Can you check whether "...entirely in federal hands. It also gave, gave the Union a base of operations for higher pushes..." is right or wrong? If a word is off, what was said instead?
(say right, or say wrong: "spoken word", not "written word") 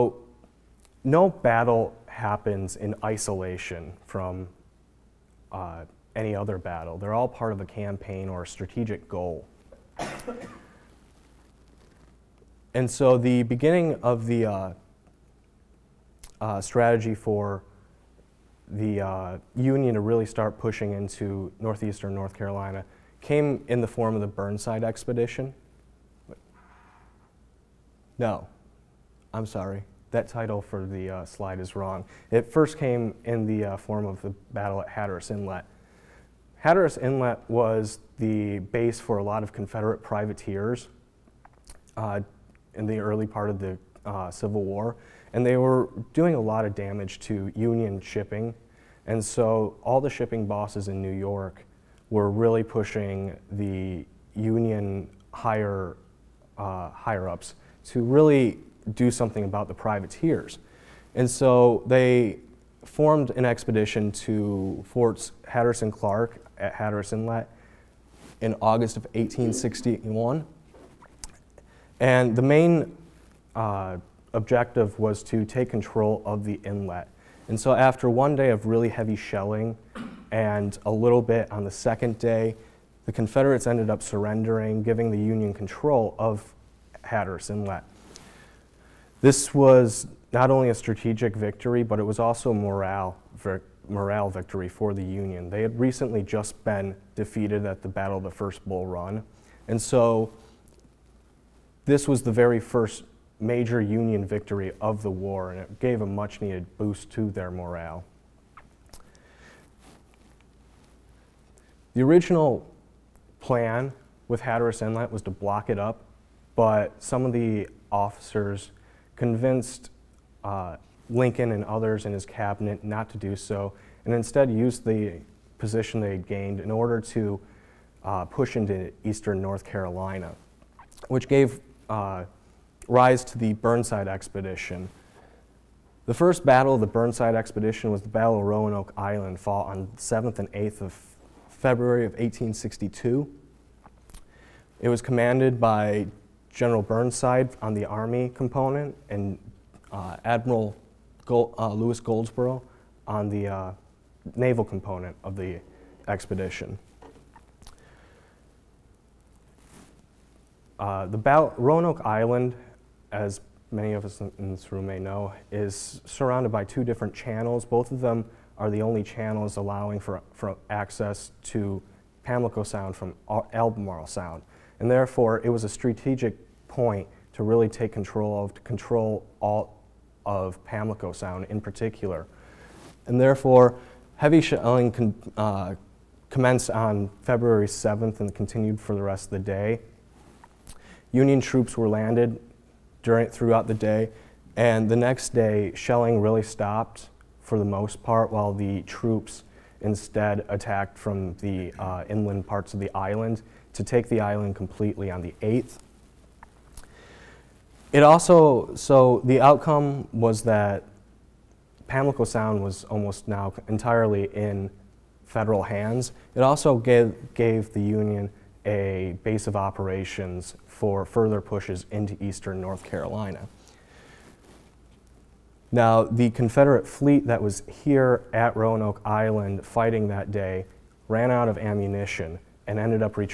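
wrong: "further", not "higher".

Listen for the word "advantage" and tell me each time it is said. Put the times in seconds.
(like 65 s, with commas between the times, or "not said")
not said.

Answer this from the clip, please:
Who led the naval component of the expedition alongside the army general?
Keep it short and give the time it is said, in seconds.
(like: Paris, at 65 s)
Louis Goldsborough, at 151 s.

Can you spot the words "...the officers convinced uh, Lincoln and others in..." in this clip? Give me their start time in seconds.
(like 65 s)
117 s.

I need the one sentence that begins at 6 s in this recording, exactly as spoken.
They're all part of a campaign or a strategic goal.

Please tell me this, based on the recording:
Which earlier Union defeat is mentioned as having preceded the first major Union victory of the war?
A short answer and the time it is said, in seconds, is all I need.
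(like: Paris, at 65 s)
First Bull Run, at 98 s.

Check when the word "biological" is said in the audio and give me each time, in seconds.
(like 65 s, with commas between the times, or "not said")
not said.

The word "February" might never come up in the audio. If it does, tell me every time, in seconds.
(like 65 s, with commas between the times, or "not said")
141 s, 187 s.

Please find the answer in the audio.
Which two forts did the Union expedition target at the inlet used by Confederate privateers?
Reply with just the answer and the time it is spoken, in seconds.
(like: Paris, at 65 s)
Forts Hatteras and Clark, at 64 s.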